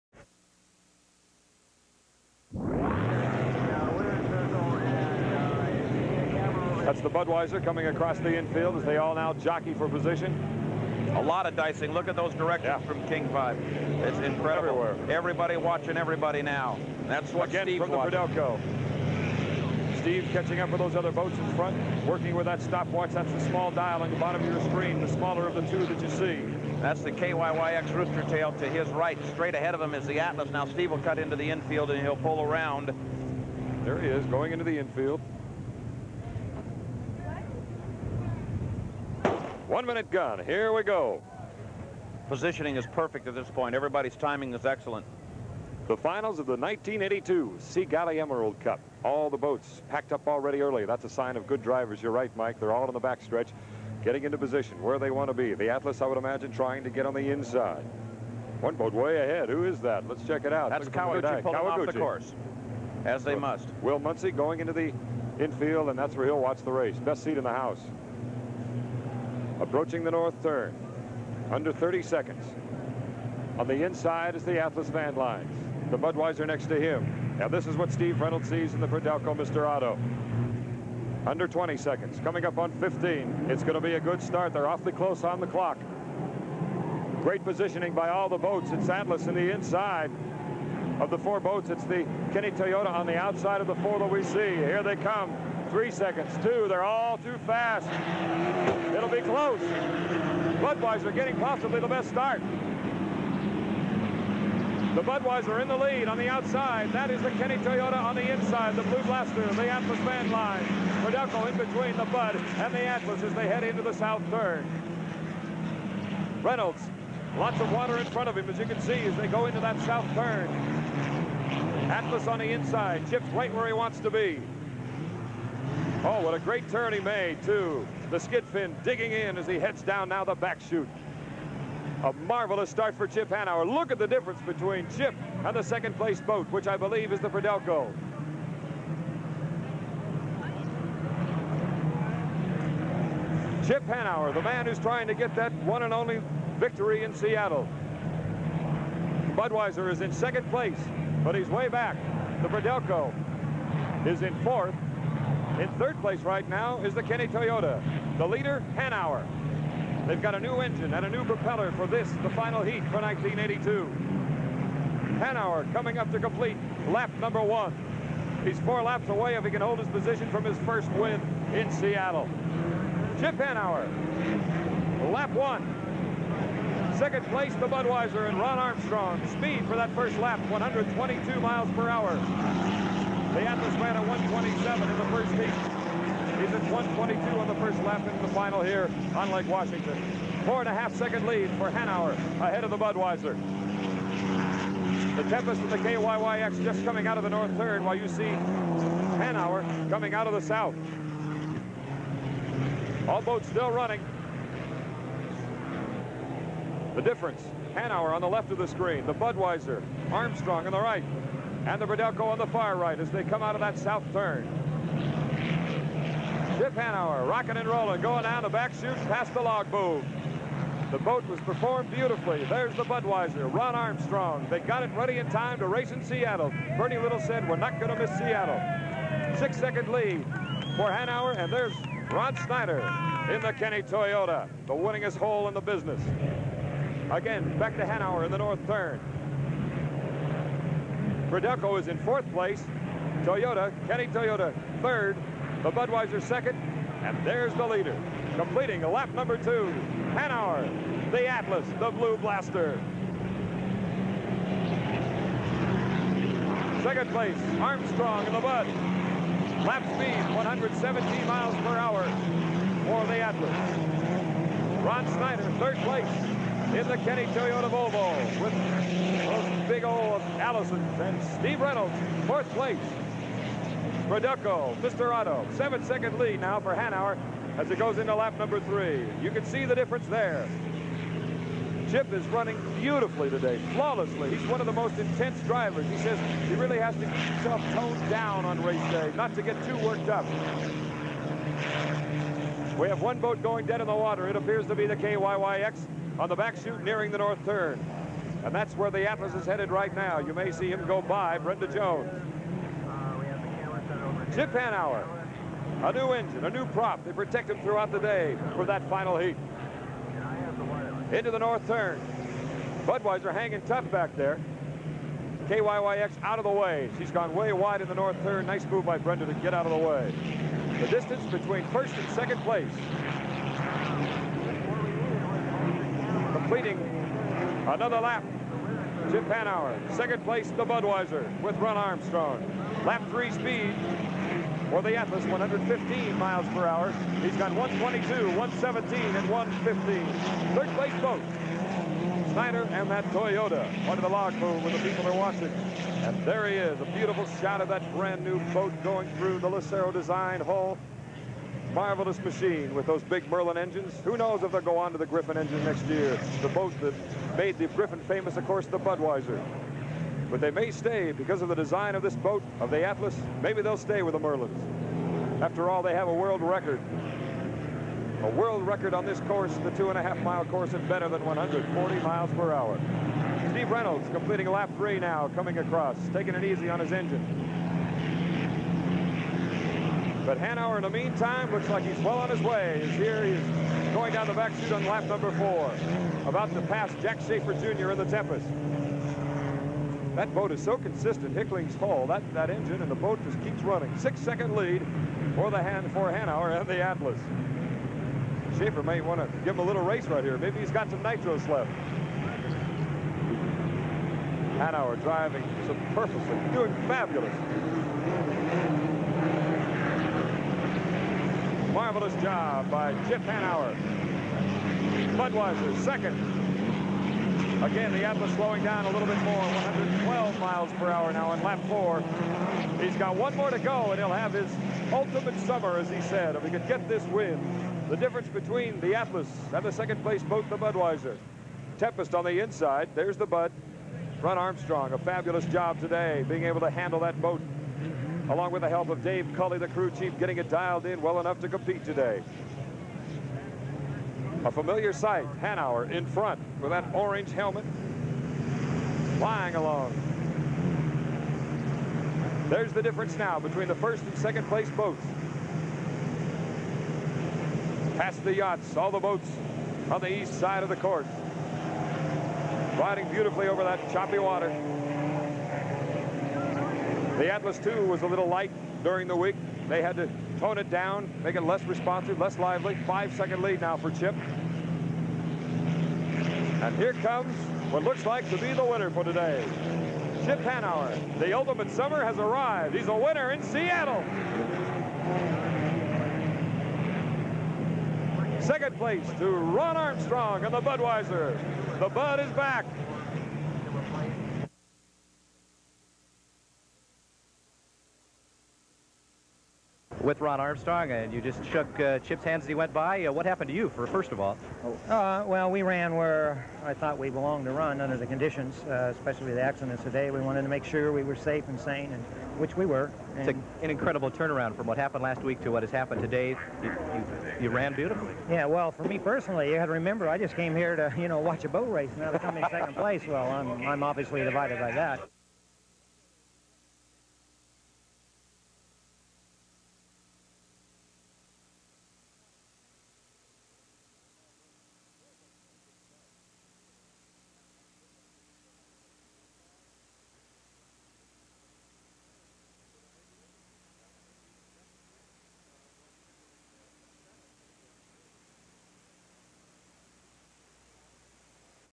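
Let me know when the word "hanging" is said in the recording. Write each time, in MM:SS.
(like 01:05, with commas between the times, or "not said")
05:13.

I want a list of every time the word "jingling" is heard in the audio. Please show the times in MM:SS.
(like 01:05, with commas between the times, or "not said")
not said.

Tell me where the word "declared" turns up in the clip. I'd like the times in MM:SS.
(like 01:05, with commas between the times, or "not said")
not said.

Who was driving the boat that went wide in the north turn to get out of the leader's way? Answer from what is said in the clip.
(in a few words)
Brenda Jones.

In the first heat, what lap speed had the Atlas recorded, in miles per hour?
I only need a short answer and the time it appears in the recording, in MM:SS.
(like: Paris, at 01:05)
127, at 03:04.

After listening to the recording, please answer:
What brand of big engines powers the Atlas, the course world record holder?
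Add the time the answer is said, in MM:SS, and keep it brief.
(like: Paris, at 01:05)
Merlin, at 05:53.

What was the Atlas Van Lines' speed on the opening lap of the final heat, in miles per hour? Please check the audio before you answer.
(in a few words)
122.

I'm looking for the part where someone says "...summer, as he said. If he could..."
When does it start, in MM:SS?
07:05.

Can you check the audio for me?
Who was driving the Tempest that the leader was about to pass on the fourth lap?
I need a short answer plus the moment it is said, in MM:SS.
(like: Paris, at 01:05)
Jack Schaefer Jr., at 06:27.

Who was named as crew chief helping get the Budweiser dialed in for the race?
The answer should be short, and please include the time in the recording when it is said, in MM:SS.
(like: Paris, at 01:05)
Dave Cully, at 07:19.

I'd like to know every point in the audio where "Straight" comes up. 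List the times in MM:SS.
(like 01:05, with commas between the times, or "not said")
00:29.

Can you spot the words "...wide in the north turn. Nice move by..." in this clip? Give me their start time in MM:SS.
05:17.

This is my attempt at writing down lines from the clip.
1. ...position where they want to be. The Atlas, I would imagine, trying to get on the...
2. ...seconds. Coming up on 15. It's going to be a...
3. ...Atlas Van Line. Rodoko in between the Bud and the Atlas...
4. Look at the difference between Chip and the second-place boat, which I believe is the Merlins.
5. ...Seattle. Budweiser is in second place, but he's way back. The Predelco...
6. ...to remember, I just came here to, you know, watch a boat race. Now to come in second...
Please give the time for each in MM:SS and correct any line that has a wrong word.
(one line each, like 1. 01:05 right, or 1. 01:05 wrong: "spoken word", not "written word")
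1. 00:54 right
2. 01:21 right
3. 01:49 right
4. 02:13 wrong: "Fidelco", not "Merlins"
5. 02:27 right
6. 08:39 right.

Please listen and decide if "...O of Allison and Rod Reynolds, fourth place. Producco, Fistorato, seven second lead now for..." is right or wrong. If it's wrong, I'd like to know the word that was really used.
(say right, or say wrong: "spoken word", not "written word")
wrong: "Steve", not "Rod".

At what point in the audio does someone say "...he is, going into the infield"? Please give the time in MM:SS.
00:34.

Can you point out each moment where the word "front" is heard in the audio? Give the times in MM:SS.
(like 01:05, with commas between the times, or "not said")
00:21, 01:58, 07:26.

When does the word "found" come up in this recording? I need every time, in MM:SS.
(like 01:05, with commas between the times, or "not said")
not said.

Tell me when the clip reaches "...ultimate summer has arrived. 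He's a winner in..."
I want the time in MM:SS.
08:01.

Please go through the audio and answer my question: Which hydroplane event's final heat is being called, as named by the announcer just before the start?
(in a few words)
Galley Emerald Cup.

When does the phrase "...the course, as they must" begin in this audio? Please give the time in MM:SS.
01:01.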